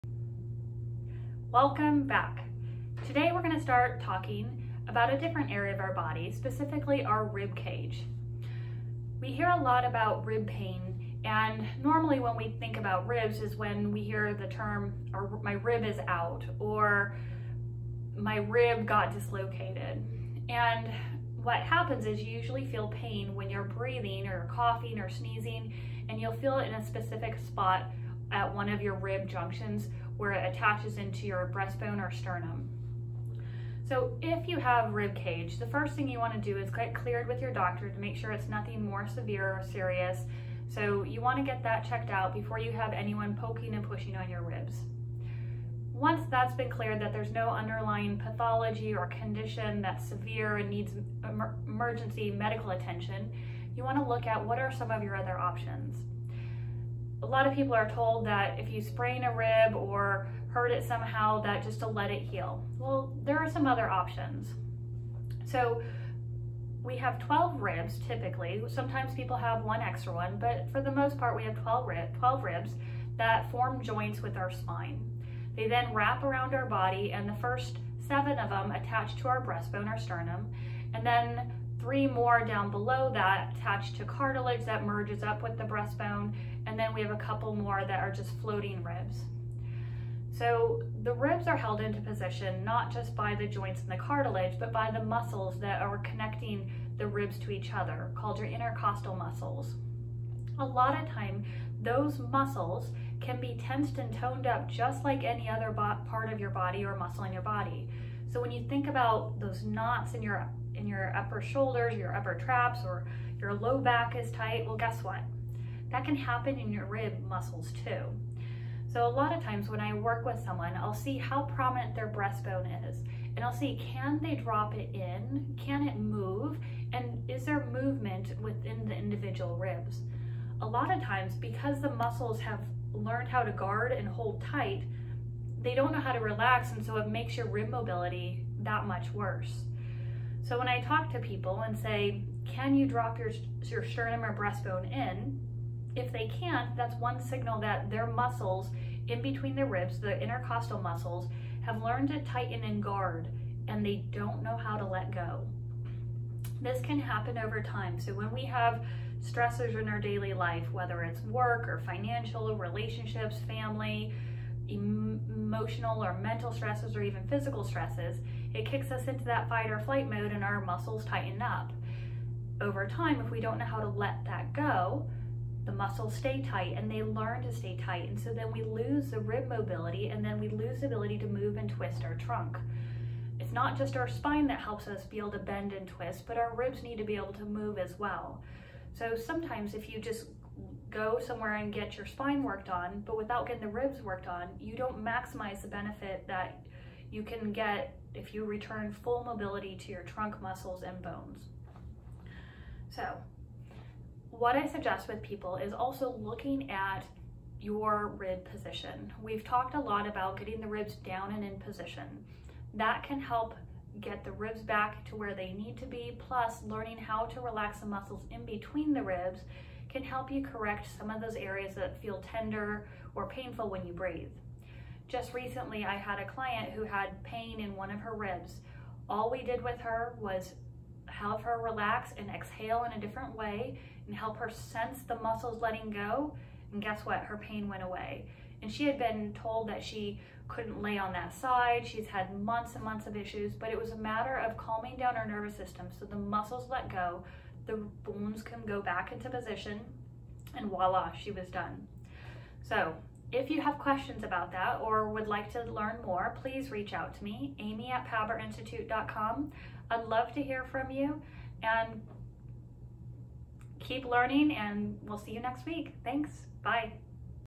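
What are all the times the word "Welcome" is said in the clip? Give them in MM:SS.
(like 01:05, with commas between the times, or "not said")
00:01.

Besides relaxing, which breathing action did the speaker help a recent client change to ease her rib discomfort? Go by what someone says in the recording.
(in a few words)
exhale.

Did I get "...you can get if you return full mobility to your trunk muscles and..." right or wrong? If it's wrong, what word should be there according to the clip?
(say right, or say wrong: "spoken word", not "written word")
right.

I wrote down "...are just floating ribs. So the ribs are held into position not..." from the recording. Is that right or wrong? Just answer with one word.
right.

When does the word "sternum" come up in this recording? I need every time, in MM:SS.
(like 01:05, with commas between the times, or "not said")
00:32, 01:19, 02:23.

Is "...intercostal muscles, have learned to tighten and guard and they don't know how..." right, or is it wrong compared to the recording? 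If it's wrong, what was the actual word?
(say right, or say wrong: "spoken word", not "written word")
right.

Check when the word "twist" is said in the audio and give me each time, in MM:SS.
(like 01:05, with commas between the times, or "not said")
03:01, 03:05.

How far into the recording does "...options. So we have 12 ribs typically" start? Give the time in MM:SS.
01:03.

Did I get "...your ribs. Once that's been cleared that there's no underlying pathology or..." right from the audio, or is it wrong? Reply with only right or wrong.
right.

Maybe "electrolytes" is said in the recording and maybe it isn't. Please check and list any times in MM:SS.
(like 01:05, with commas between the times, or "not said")
not said.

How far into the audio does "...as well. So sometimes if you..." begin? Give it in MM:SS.
03:07.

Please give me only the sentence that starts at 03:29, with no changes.
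We've talked a lot about getting the ribs down and in position.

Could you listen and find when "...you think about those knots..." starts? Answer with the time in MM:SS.
01:48.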